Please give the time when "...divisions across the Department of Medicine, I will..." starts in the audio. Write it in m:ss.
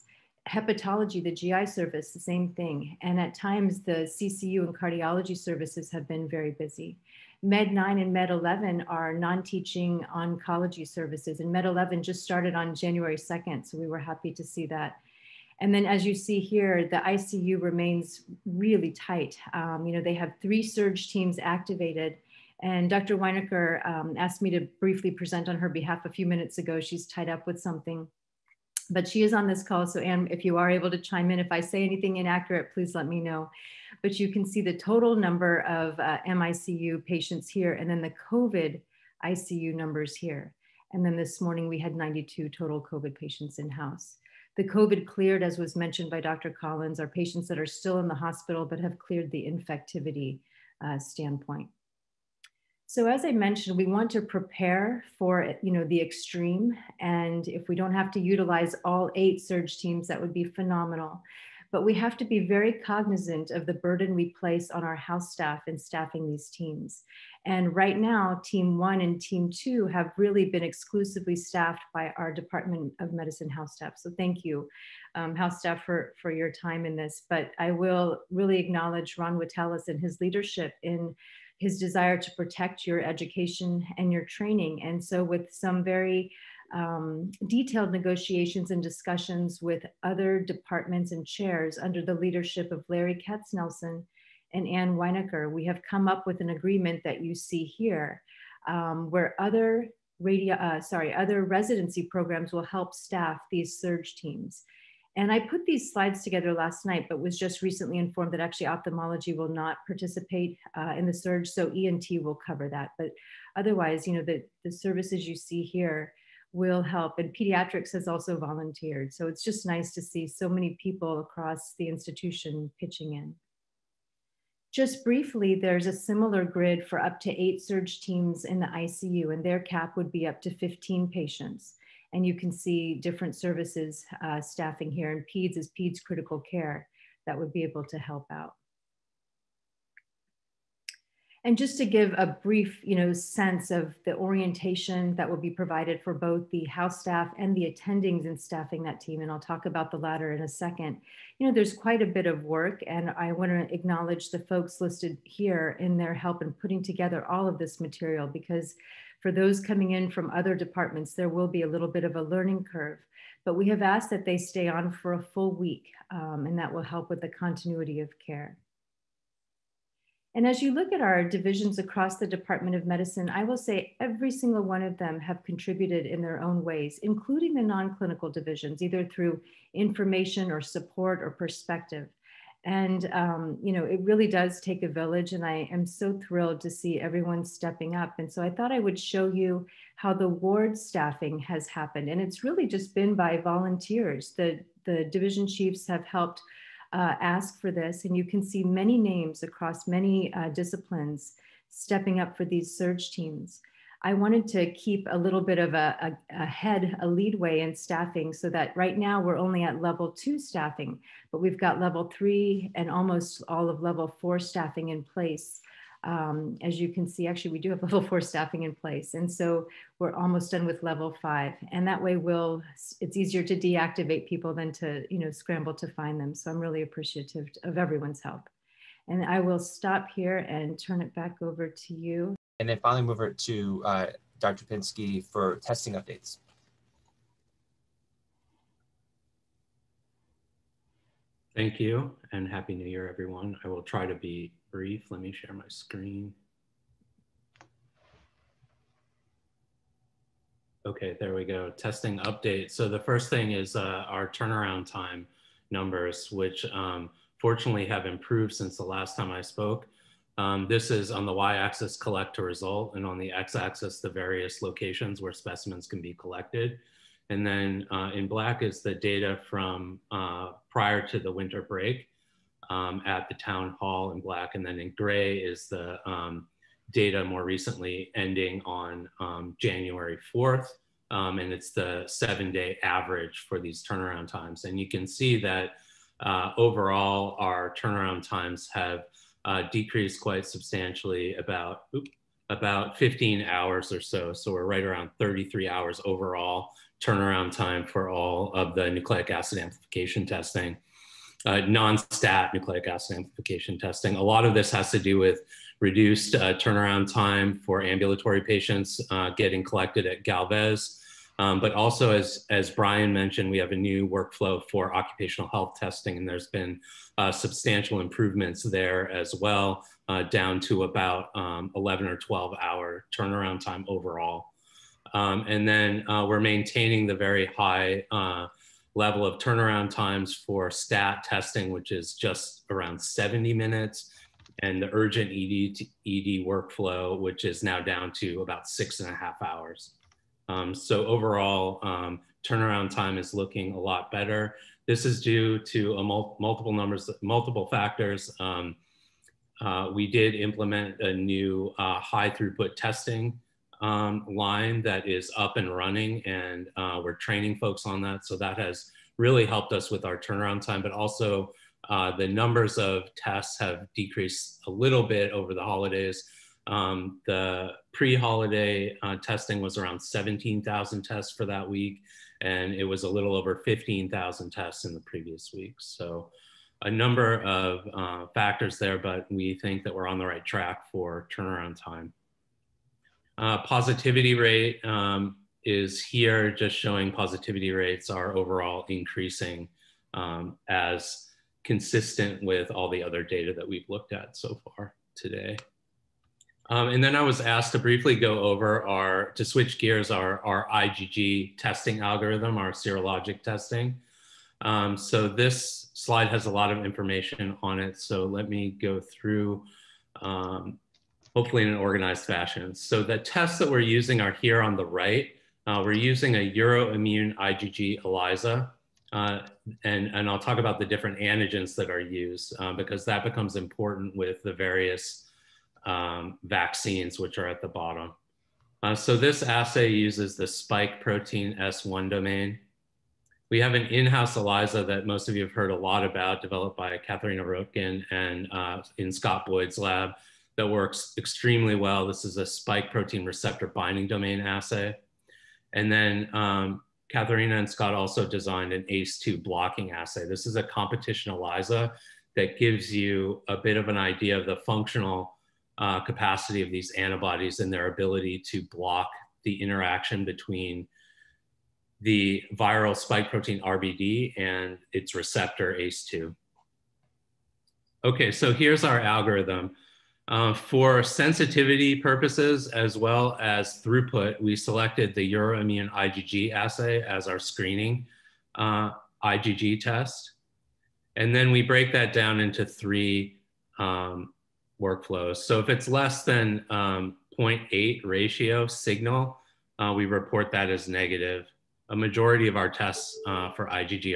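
2:51.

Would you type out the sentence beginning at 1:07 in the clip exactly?
And right now, Team One and Team Two have really been exclusively staffed by our Department of Medicine house staff.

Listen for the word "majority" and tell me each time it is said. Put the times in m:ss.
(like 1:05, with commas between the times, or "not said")
8:11.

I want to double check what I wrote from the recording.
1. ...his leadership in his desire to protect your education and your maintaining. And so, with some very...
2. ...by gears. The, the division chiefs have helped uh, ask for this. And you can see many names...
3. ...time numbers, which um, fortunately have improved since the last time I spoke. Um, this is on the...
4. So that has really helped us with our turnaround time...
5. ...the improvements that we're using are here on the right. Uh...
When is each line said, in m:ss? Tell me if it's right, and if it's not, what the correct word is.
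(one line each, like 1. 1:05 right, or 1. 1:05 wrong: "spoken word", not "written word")
1. 1:19 wrong: "training", not "maintaining"
2. 3:13 wrong: "volunteers", not "gears"
3. 4:14 right
4. 5:58 right
5. 6:53 wrong: "tests", not "improvements".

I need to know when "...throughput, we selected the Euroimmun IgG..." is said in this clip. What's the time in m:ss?
7:53.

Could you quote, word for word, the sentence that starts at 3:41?
And that way we'll, it's easier to deactivate people than to, you know, scramble to find them.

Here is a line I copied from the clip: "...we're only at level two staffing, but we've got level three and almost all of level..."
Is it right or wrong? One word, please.
right.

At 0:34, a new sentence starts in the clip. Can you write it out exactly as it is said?
But you can see the total number of uh, MICU patients here and then the COVID ICU numbers here.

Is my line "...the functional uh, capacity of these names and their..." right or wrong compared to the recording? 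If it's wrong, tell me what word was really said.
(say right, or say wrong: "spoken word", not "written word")
wrong: "antibodies", not "names".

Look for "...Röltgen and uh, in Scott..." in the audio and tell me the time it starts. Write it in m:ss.
7:17.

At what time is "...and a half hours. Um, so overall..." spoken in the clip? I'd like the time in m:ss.
5:38.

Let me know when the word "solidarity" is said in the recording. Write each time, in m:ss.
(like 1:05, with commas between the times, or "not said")
not said.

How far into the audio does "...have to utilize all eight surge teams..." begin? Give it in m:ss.
0:57.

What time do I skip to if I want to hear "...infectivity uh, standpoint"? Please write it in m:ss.
0:49.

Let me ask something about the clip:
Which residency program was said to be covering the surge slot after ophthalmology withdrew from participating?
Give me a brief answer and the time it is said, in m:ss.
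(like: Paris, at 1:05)
ENT, at 1:51.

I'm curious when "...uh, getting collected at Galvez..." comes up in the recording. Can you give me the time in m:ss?
5:09.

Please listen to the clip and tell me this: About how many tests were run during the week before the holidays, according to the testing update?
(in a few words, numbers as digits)
17,000.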